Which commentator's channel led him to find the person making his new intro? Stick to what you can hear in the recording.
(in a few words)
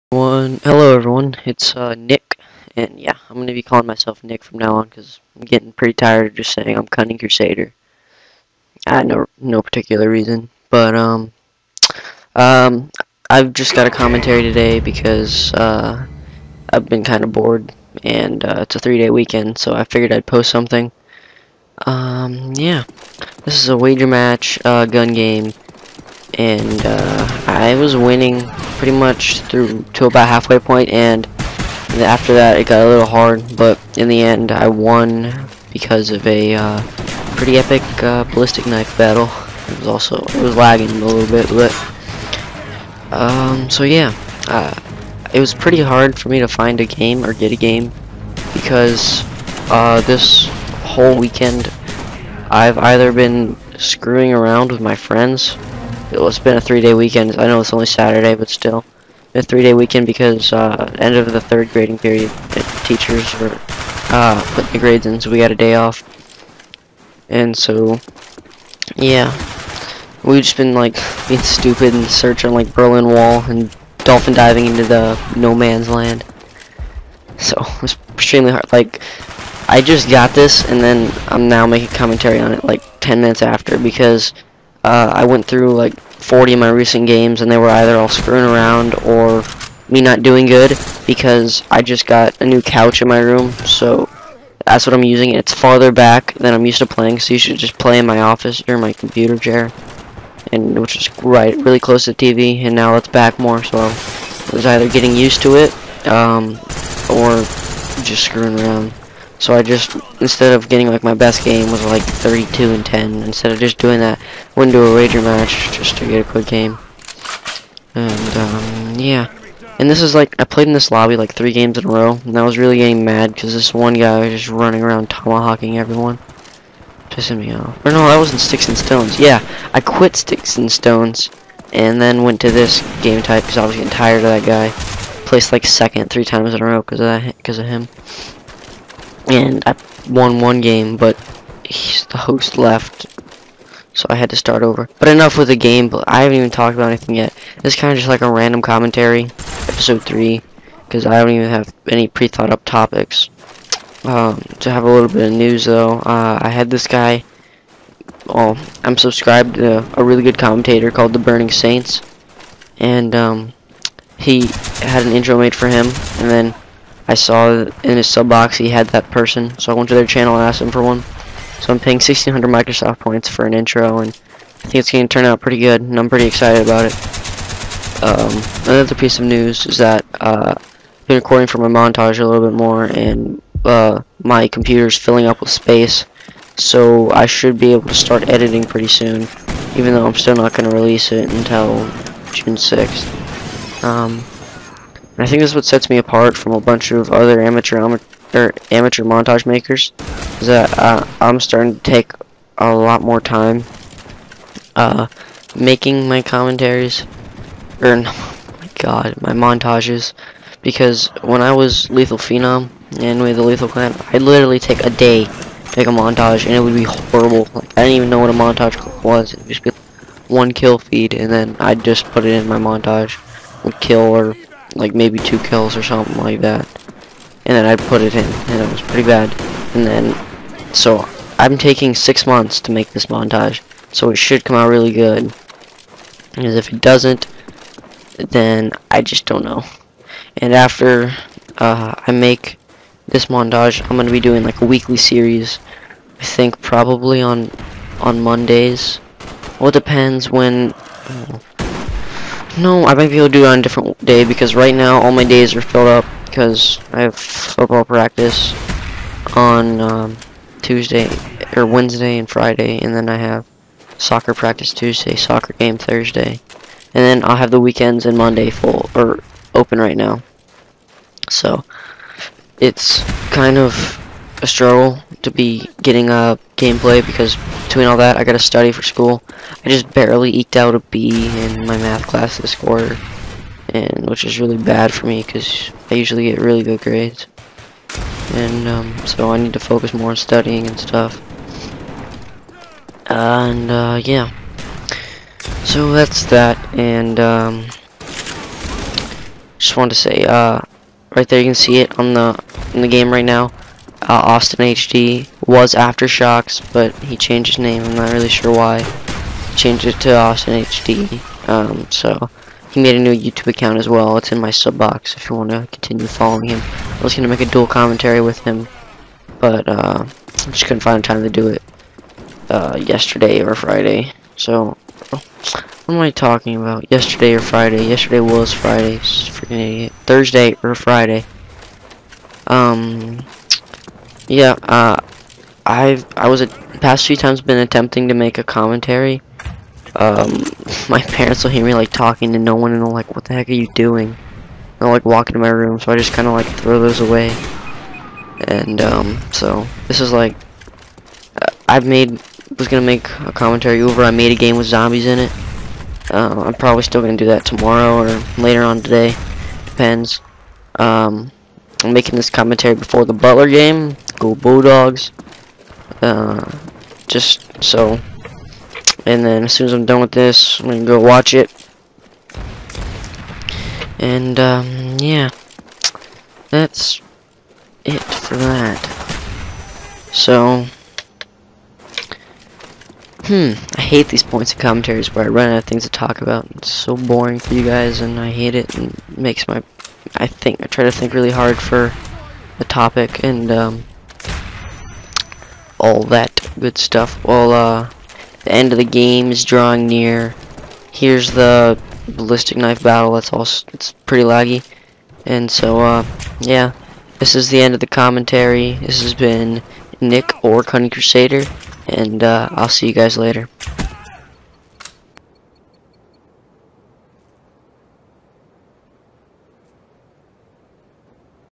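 The Burning Saints.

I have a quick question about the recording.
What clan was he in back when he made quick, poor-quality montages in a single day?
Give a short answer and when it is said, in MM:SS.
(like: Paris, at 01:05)
Lethal Clan, at 03:33.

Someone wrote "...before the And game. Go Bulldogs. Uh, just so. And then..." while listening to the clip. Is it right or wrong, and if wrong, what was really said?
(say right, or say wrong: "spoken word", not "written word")
wrong: "Butler", not "And".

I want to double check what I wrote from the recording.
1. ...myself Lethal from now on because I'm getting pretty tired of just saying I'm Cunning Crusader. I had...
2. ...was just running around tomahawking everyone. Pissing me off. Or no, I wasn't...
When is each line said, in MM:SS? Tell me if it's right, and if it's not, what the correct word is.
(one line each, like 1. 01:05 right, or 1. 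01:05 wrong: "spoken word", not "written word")
1. 00:03 wrong: "Nick", not "Lethal"
2. 02:04 right.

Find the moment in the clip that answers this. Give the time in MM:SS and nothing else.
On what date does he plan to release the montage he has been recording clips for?
03:12.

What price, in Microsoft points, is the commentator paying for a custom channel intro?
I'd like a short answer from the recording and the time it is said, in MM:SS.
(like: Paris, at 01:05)
1600, at 02:51.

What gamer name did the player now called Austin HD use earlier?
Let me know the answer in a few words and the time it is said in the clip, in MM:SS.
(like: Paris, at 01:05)
Aftershocks, at 05:05.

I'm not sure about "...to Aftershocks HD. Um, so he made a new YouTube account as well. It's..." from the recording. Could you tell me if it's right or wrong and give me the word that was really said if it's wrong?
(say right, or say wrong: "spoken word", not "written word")
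wrong: "Austin", not "Aftershocks".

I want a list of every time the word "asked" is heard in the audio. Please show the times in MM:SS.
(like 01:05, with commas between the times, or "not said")
02:50.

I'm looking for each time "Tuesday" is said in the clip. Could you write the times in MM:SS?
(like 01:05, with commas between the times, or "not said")
04:20, 04:24.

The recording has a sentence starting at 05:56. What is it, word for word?
Um, I'm probably still gonna do that tomorrow or later on today.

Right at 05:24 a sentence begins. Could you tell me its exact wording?
So what am I talking about?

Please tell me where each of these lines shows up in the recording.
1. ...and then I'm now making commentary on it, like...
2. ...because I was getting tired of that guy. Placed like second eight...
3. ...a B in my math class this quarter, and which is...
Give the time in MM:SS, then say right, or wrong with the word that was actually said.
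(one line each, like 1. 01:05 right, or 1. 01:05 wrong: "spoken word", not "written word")
1. 01:20 right
2. 02:13 wrong: "three", not "eight"
3. 04:40 right.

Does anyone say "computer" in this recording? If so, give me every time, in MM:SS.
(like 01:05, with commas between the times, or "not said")
01:38, 03:04.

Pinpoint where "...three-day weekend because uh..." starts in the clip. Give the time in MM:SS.
00:59.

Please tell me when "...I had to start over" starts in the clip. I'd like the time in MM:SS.
02:24.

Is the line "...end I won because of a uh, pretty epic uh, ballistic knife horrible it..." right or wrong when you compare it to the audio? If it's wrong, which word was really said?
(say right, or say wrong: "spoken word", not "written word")
wrong: "battle", not "horrible".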